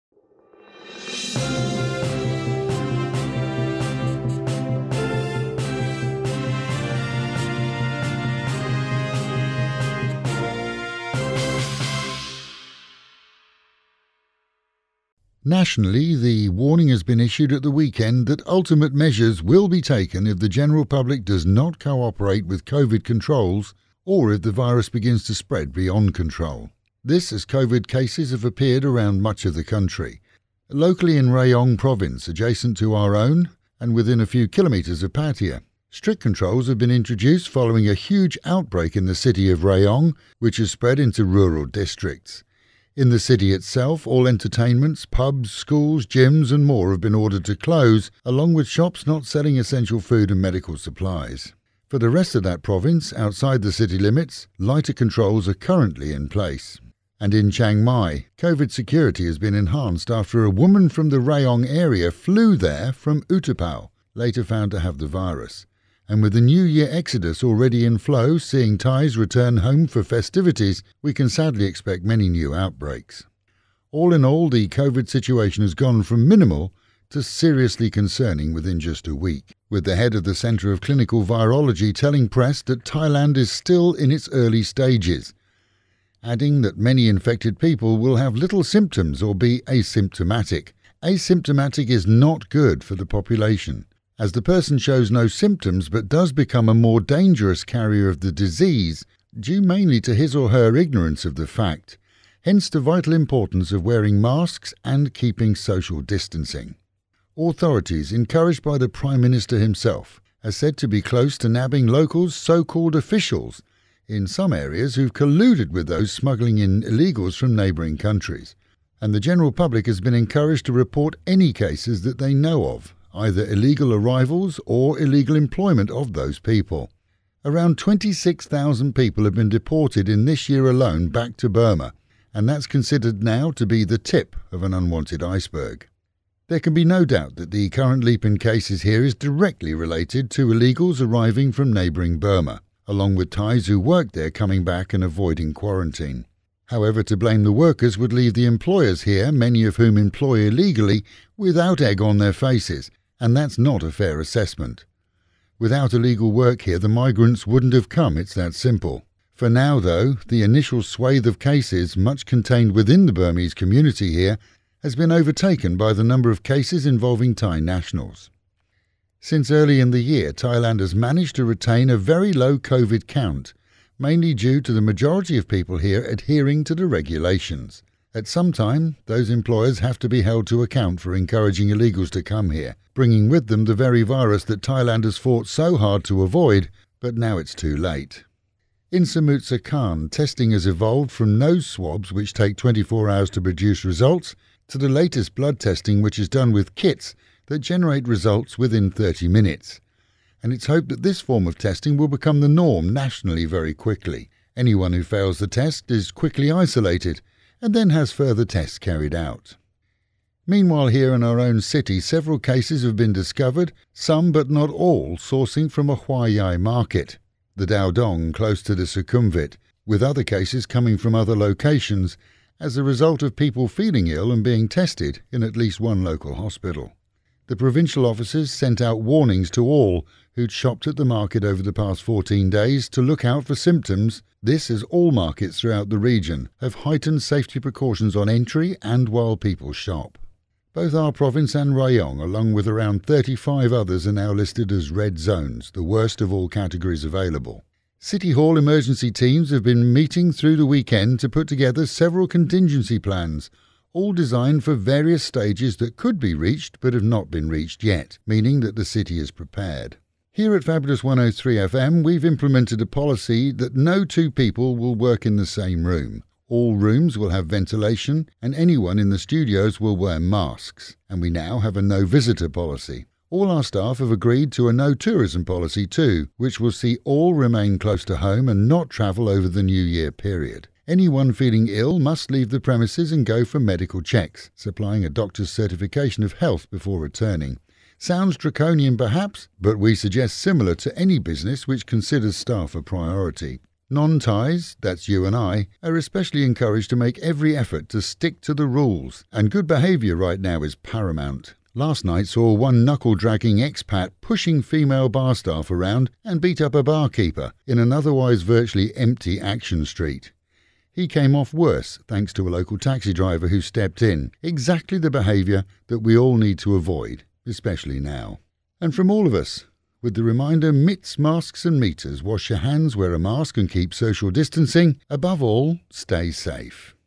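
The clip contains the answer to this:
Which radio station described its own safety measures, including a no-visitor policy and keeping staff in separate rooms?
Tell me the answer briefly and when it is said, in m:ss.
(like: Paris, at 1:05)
Fabulous 103 FM, at 4:20.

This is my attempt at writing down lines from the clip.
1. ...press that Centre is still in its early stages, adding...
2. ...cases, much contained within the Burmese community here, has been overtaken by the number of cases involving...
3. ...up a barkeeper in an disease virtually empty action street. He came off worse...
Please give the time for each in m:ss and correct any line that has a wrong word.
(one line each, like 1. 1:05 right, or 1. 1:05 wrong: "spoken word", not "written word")
1. 1:22 wrong: "Thailand", not "Centre"
2. 2:41 right
3. 5:06 wrong: "otherwise", not "disease".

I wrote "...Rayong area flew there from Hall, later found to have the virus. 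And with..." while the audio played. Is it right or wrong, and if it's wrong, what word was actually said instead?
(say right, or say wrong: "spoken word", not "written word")
wrong: "Utapao", not "Hall".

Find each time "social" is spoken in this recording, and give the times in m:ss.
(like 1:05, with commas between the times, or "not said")
1:45, 5:23.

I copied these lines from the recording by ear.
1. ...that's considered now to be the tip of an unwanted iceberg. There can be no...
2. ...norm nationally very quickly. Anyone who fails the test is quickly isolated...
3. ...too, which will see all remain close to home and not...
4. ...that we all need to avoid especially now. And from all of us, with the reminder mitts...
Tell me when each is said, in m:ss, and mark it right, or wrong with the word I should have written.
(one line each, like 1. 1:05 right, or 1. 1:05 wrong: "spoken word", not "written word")
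1. 2:12 right
2. 3:22 right
3. 4:35 right
4. 5:15 right.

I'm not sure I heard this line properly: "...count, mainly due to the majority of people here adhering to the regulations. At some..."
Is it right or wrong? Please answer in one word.
right.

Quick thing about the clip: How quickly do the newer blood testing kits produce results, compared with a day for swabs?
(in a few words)
30 minutes.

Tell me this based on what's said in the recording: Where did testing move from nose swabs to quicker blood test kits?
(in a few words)
Samut Sakhorn.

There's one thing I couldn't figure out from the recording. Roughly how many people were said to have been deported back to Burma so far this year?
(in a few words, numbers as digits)
26,000.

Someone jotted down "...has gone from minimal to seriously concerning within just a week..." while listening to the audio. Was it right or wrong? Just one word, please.
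right.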